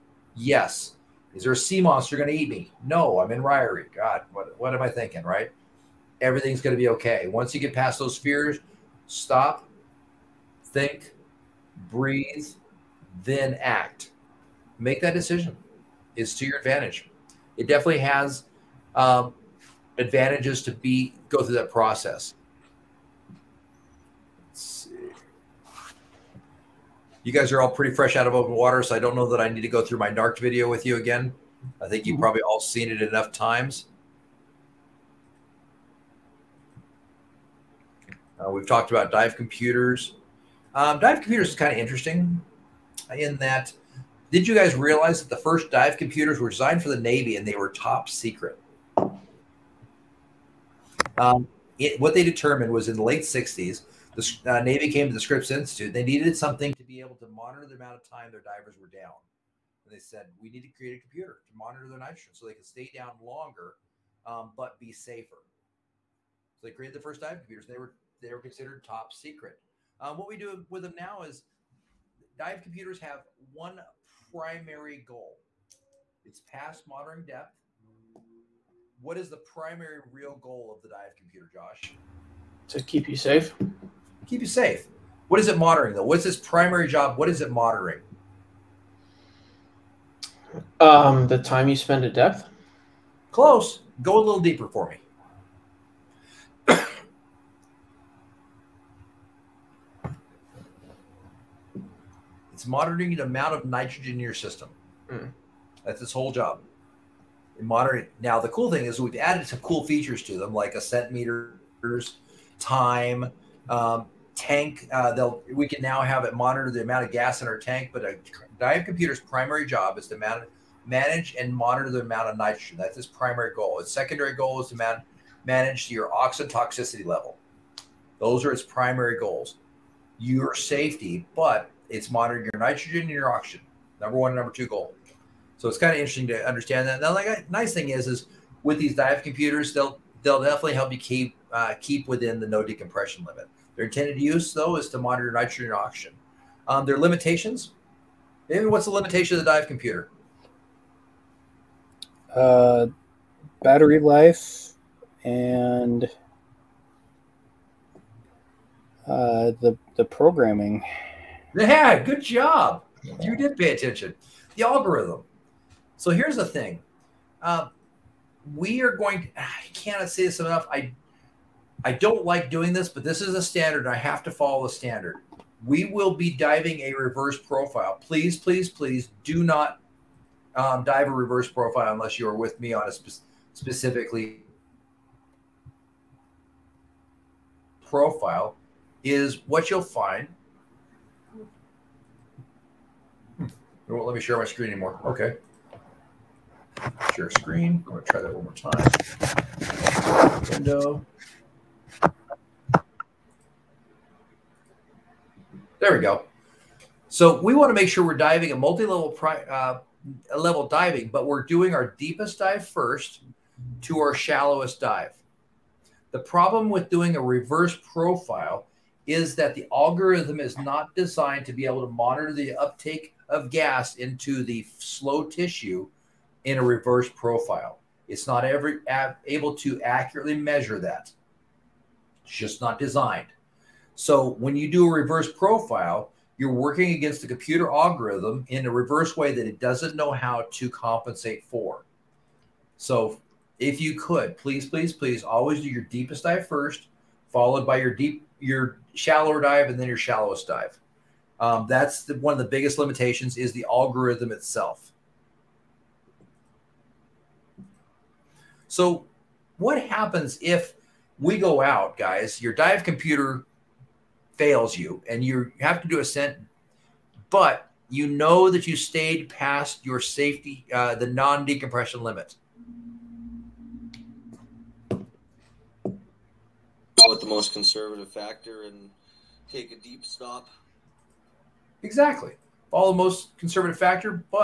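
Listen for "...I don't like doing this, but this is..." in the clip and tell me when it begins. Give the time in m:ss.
2:51.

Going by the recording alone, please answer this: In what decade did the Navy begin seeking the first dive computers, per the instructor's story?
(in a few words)
late 60s.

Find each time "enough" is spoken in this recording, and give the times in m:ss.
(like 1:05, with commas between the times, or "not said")
0:33, 2:50.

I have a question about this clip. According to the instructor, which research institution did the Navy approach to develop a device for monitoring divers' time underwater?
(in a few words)
Scripps Institute.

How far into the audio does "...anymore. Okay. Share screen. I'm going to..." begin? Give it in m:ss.
3:14.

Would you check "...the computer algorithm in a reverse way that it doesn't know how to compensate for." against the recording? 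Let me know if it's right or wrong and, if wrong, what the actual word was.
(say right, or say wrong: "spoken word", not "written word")
right.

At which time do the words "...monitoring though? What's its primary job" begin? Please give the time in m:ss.
1:25.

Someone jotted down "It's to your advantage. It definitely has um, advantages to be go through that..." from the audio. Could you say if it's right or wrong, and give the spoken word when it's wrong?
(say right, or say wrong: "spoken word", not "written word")
right.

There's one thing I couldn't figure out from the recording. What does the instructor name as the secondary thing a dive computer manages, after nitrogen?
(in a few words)
oxygen toxicity level.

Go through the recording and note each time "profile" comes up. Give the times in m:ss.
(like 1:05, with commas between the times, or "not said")
2:57, 3:01, 3:07, 3:37, 3:47, 3:55.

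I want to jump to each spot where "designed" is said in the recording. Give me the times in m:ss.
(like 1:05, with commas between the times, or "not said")
0:46, 3:40, 3:52.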